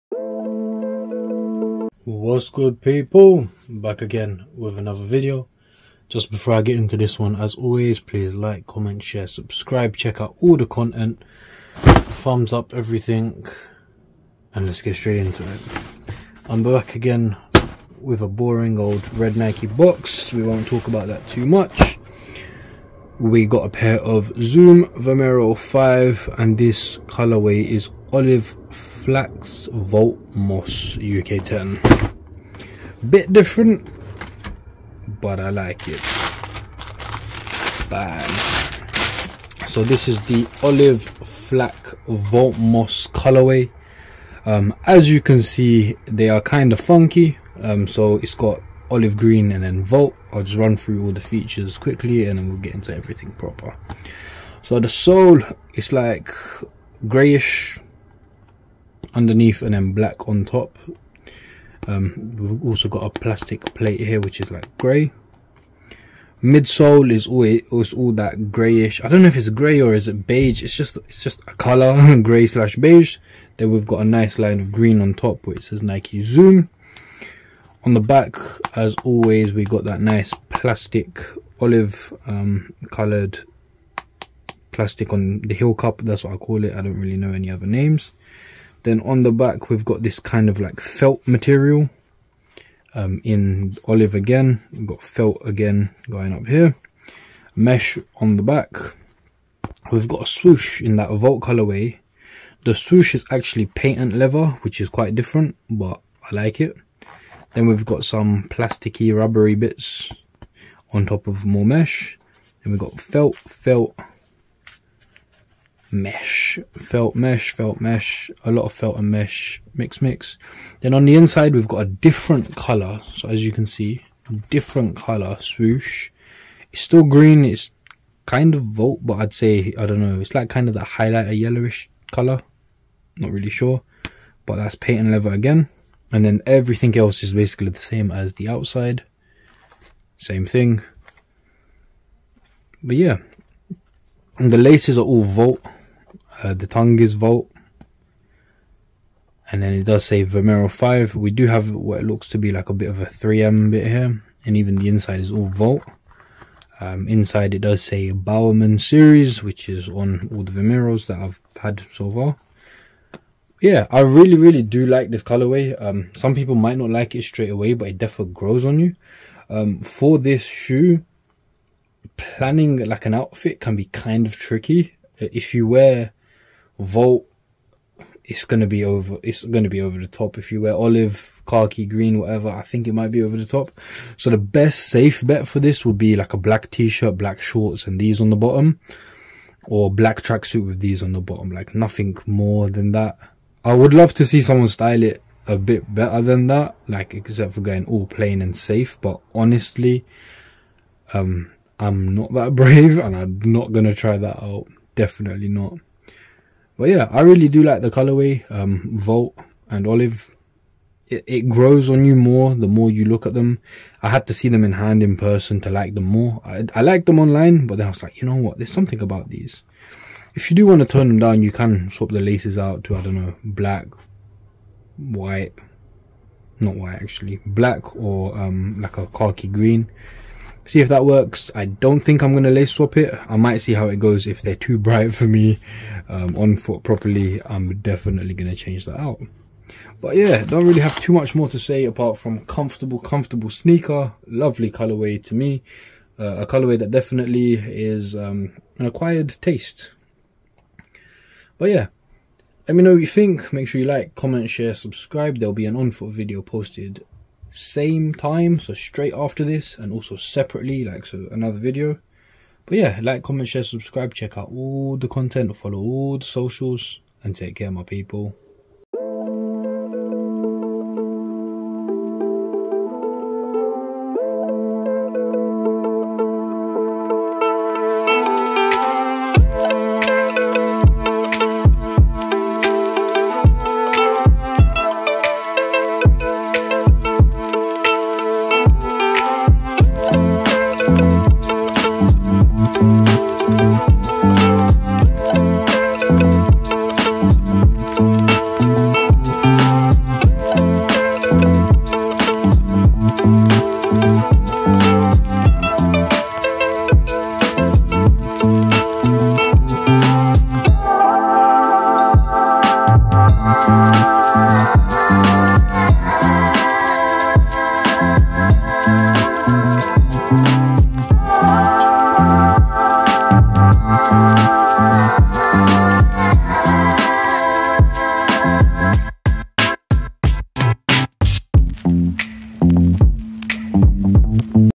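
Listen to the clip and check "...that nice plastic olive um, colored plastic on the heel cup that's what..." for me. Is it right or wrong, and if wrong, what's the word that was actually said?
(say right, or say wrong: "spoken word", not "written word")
right.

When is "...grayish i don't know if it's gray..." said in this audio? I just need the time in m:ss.
1:08.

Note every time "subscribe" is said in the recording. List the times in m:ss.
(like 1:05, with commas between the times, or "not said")
0:09, 4:14, 4:23.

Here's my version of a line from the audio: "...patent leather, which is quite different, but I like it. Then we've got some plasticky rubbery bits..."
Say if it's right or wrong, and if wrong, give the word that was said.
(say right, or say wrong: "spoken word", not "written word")
right.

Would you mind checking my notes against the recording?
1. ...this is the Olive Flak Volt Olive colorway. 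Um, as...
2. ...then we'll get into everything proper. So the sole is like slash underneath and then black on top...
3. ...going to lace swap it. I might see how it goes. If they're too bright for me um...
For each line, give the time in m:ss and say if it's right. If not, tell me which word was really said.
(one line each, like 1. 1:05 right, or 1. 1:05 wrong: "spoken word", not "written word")
1. 0:39 wrong: "Moss", not "Olive"
2. 0:52 wrong: "grayish", not "slash"
3. 3:52 right.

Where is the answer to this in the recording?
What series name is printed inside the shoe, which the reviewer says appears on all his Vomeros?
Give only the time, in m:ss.
2:38.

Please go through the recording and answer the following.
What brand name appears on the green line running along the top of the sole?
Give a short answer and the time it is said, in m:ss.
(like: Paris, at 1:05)
Nike Zoom, at 1:15.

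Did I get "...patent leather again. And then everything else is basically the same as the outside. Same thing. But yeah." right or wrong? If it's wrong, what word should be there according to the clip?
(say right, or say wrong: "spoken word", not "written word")
right.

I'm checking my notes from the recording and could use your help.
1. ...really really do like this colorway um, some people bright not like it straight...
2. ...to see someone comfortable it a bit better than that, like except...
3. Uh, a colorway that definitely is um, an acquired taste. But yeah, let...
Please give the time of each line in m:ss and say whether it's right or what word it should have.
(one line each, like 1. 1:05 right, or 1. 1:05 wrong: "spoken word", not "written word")
1. 2:43 wrong: "might", not "bright"
2. 3:14 wrong: "style", not "comfortable"
3. 4:06 right.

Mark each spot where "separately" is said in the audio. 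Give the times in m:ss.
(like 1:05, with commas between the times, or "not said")
4:20.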